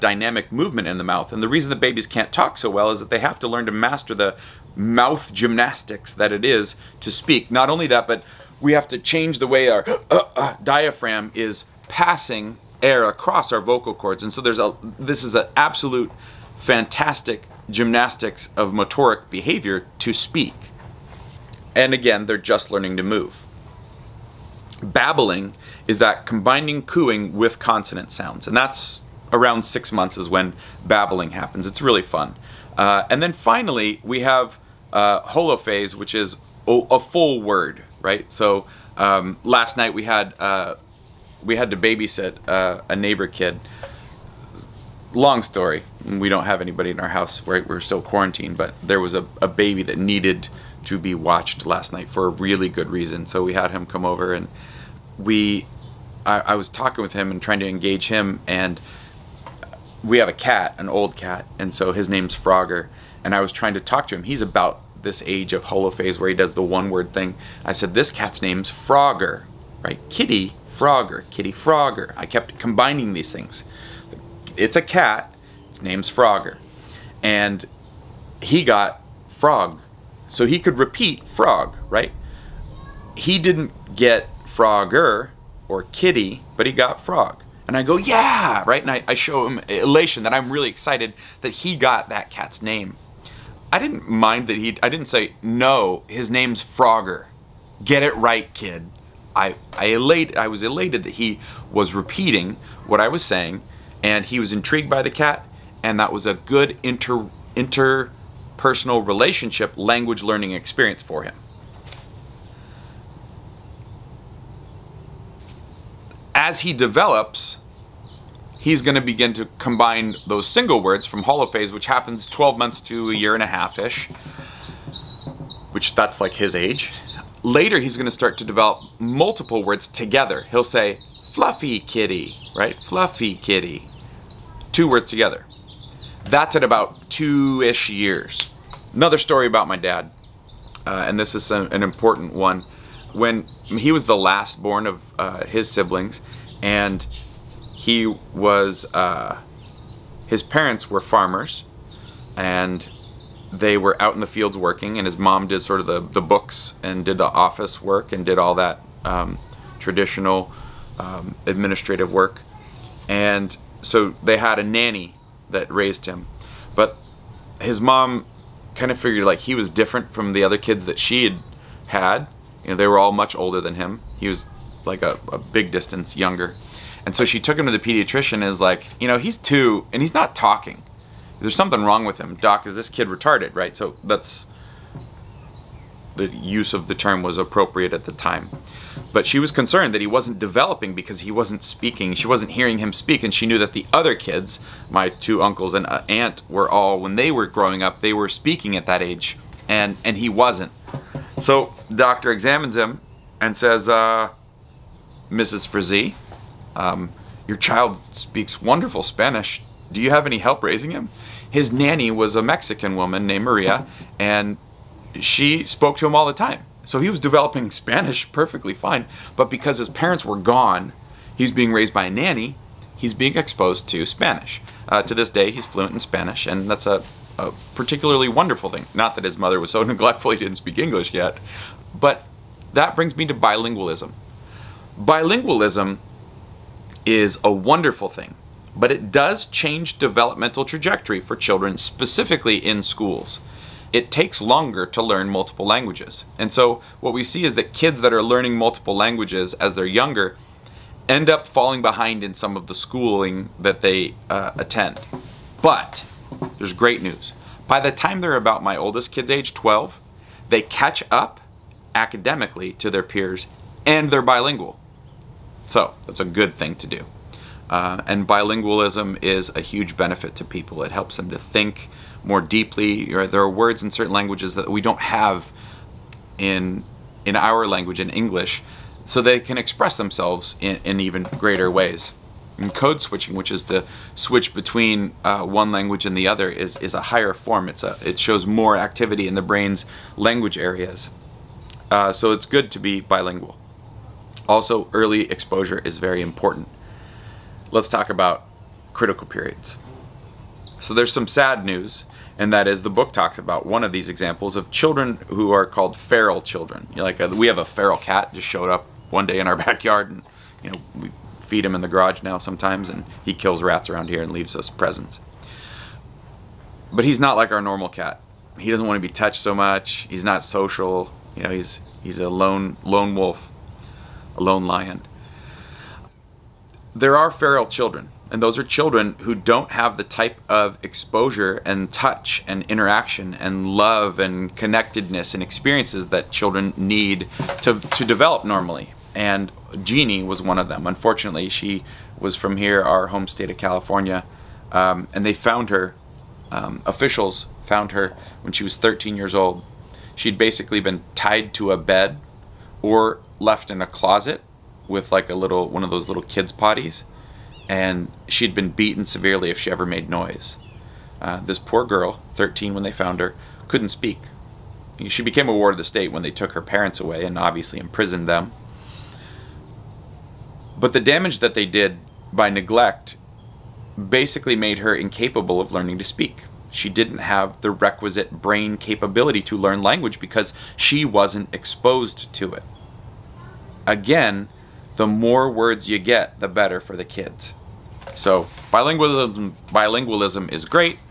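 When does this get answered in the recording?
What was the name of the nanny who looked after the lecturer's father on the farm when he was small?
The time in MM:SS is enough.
03:33.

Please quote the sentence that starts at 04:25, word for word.
So that's a good thing to do.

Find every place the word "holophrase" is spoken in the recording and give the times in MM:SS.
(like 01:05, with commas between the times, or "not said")
00:35, 01:05, 02:01.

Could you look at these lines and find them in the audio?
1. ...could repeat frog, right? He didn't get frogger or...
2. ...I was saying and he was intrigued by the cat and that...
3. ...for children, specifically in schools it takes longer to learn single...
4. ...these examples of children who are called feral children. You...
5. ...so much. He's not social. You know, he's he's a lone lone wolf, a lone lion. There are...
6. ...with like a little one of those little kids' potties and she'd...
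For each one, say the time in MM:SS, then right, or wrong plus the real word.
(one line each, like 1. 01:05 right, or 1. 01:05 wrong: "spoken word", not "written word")
1. 01:20 right
2. 01:42 right
3. 04:01 wrong: "multiple", not "single"
4. 05:03 right
5. 05:19 right
6. 05:54 right.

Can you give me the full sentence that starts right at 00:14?
And so there's a this is an absolute fantastic gymnastics of motoric behavior to speak.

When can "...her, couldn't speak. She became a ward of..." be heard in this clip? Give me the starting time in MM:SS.
06:03.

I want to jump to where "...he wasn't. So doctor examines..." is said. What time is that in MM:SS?
03:20.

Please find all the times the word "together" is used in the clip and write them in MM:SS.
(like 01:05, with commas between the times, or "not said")
02:09, 02:15.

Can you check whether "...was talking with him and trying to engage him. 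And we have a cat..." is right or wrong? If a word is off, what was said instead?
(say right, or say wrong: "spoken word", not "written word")
right.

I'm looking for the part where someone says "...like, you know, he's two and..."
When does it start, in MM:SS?
02:58.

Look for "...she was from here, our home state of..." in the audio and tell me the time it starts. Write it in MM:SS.
05:41.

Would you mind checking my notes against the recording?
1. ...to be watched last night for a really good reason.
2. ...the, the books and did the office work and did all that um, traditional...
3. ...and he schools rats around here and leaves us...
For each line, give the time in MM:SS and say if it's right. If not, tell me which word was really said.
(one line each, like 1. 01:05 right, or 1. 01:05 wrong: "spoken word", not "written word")
1. 00:50 right
2. 02:35 right
3. 05:12 wrong: "kills", not "schools".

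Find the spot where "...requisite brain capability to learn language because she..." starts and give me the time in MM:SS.
06:17.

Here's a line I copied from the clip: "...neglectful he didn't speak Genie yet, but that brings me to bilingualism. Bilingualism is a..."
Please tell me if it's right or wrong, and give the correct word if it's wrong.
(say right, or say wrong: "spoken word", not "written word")
wrong: "English", not "Genie".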